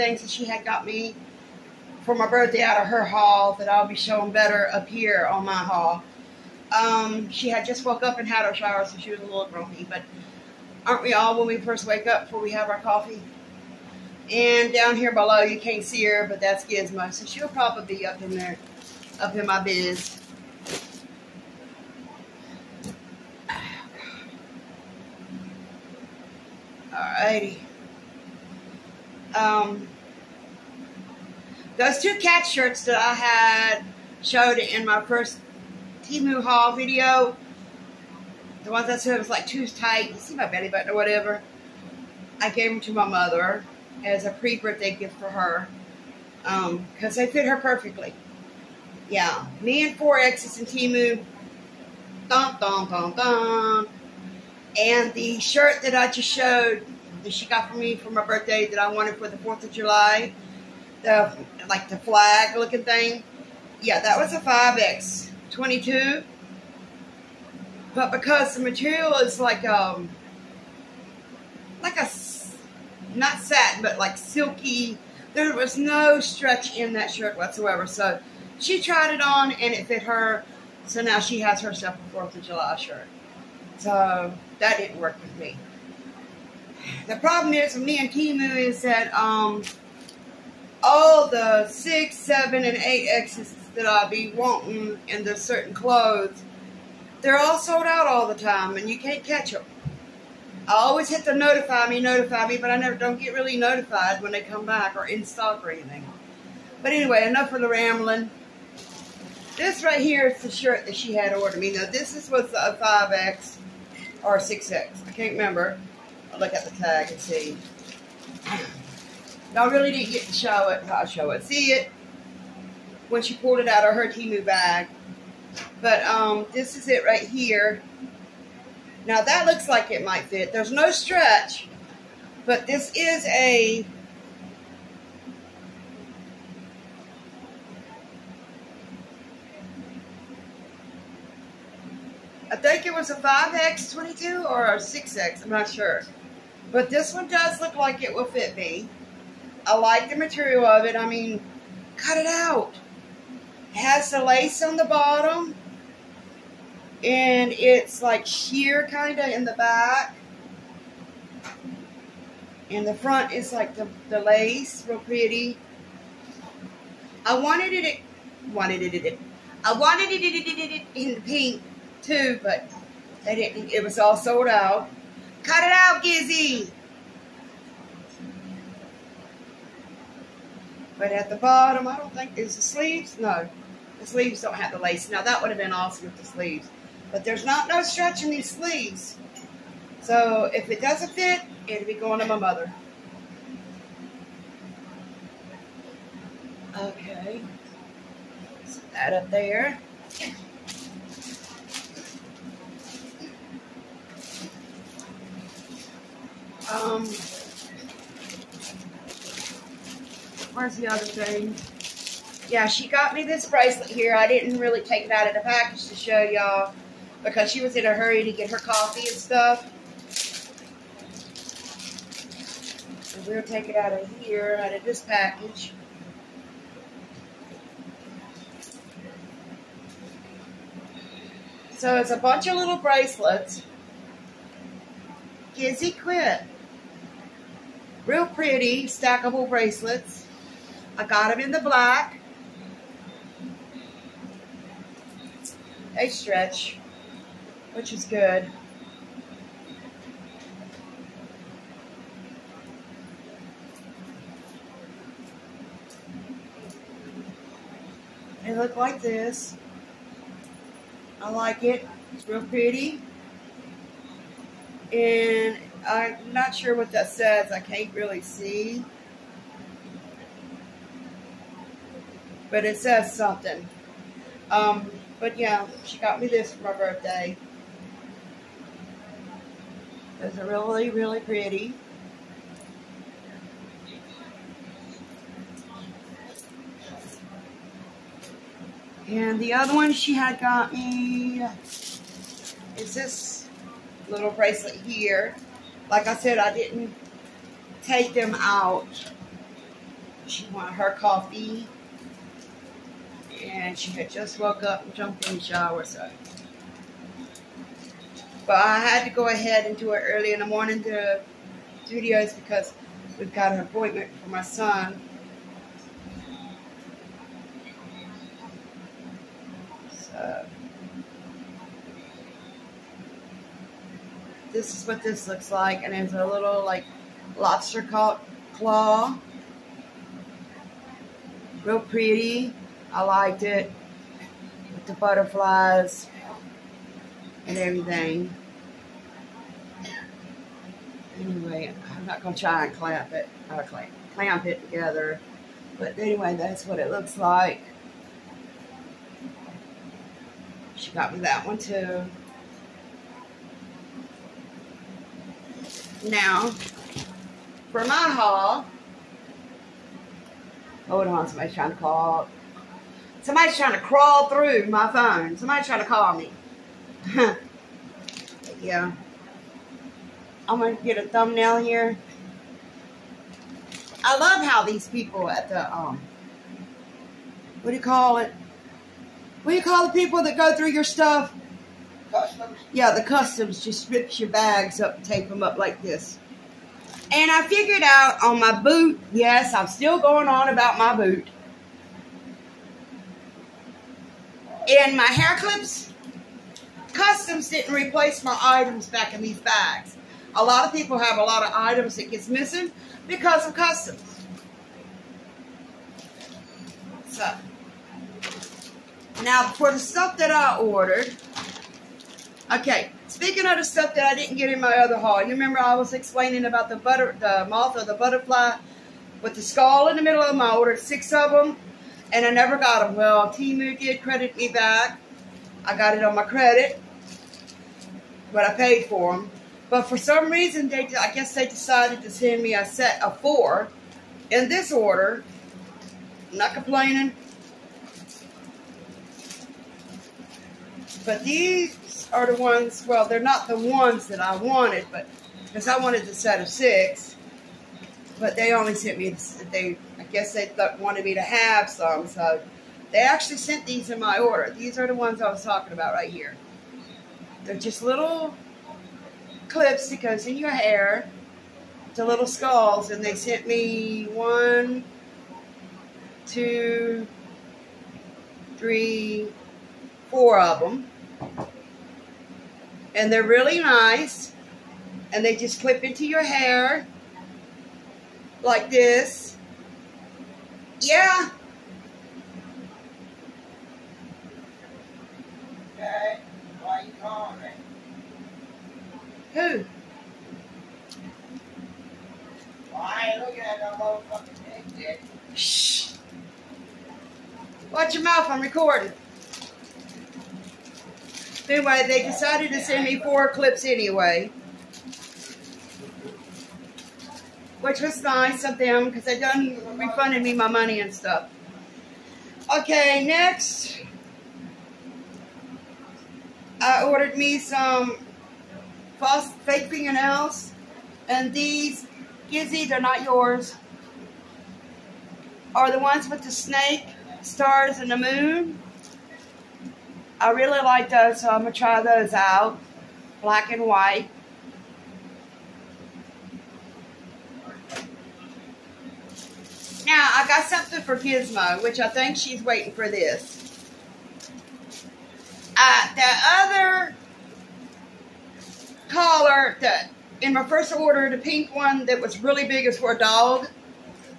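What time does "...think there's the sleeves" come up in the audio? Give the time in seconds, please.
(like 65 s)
182 s.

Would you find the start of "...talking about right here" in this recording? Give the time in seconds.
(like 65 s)
455 s.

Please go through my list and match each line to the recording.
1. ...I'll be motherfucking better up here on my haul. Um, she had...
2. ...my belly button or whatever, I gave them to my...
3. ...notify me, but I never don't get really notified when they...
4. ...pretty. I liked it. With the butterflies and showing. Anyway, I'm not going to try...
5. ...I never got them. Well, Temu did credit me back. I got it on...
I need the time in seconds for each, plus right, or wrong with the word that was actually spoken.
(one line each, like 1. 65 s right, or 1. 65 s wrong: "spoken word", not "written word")
1. 3 s wrong: "showing", not "motherfucking"
2. 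40 s right
3. 101 s right
4. 331 s wrong: "everything", not "showing"
5. 422 s right.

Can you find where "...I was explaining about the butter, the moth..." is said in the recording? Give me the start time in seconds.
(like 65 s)
415 s.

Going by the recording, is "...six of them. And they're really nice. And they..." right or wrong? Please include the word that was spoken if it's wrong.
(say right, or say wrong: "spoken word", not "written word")
wrong: "four", not "six".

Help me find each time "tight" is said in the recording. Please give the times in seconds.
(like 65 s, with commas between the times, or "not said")
39 s.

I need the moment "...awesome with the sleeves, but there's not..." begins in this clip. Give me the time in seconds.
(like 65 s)
185 s.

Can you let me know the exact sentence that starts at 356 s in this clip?
Now, for my haul, hold on, somebody's trying to call.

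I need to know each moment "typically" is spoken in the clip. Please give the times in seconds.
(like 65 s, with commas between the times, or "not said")
not said.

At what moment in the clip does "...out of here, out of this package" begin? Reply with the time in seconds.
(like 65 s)
223 s.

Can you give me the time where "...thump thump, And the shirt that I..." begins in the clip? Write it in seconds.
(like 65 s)
52 s.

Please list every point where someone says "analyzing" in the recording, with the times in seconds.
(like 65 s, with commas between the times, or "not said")
not said.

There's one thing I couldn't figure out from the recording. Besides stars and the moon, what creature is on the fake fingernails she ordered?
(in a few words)
snake.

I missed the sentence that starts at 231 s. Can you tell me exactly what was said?
So it's a bunch of little bracelets.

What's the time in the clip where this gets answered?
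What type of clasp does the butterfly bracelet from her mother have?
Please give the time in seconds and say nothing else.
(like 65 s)
327 s.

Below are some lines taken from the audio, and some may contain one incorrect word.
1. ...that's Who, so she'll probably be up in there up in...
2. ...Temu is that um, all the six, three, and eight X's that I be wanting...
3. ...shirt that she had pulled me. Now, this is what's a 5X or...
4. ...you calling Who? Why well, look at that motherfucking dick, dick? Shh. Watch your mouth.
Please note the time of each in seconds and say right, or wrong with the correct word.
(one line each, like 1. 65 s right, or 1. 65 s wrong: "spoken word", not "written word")
1. 16 s wrong: "Gizmo", not "Who"
2. 88 s wrong: "seven", not "three"
3. 110 s wrong: "ordered", not "pulled"
4. 486 s right.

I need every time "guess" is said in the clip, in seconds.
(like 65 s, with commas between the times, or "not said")
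431 s, 450 s.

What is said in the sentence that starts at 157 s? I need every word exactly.
And it's like sheer kind of in the back.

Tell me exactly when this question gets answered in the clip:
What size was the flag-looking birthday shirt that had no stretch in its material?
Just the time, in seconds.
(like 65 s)
64 s.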